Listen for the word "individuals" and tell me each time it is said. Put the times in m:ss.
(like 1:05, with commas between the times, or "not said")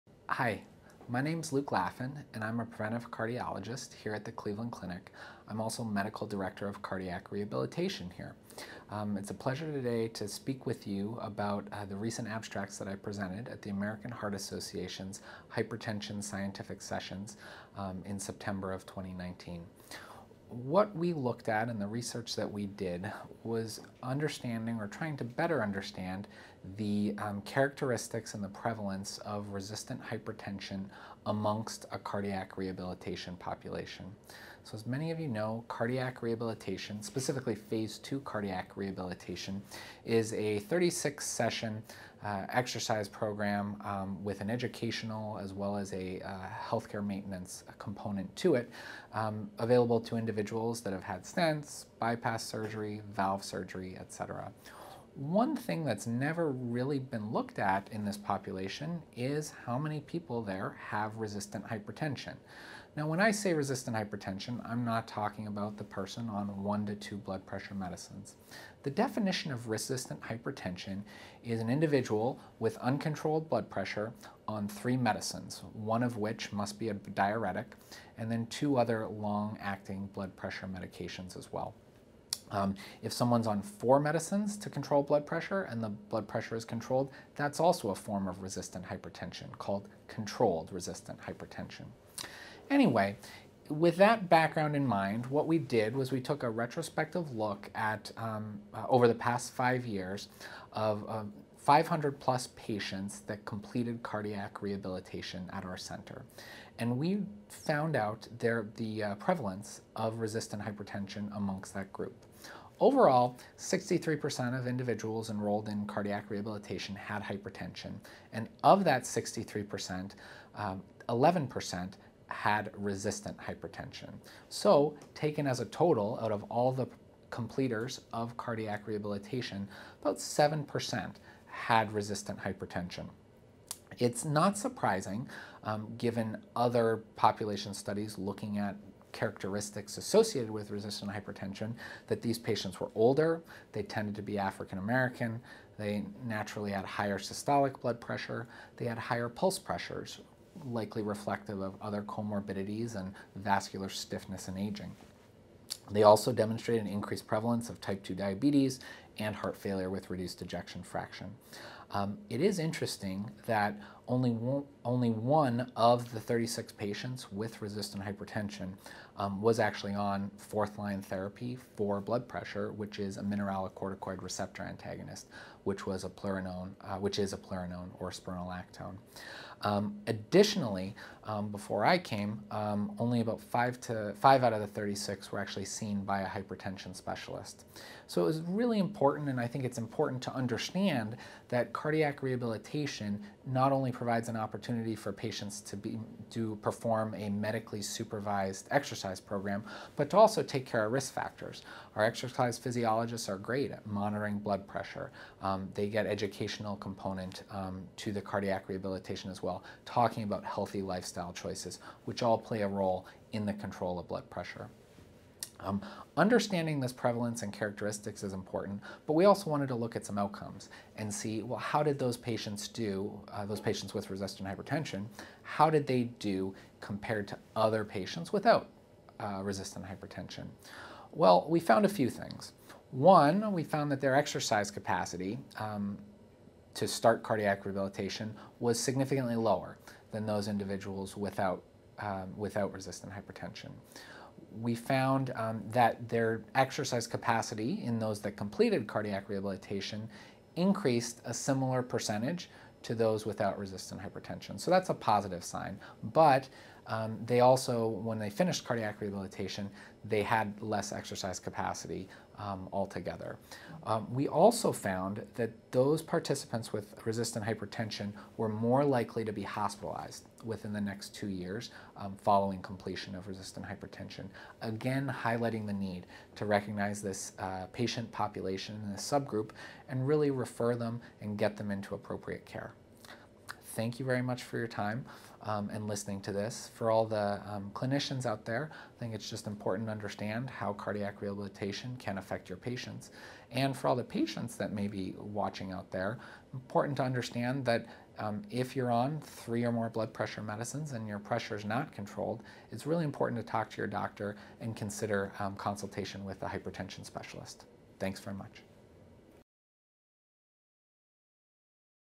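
0:50, 1:11, 1:54, 4:00.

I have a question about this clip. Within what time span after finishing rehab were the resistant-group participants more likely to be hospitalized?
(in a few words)
2 years.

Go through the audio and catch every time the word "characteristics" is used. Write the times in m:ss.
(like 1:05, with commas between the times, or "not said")
0:27, 2:19, 3:37.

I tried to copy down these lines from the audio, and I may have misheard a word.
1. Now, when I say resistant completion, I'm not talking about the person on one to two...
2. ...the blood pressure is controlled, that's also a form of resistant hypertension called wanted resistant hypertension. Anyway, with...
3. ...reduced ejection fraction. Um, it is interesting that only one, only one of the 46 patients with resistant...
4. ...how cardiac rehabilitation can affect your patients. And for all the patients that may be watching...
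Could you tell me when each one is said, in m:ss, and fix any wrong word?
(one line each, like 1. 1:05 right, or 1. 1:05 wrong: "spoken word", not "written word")
1. 1:02 wrong: "hypertension", not "completion"
2. 1:25 wrong: "controlled", not "wanted"
3. 2:40 wrong: "36", not "46"
4. 4:50 right.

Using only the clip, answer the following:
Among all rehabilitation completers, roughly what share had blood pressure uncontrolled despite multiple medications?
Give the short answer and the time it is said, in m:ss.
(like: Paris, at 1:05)
7%, at 2:10.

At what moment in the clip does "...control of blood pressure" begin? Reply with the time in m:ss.
3:33.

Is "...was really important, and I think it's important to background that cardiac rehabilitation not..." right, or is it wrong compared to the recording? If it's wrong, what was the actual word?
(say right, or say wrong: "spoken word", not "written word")
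wrong: "understand", not "background".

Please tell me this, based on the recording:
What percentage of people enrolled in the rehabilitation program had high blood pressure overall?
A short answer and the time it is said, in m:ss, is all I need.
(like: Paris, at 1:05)
63%, at 1:52.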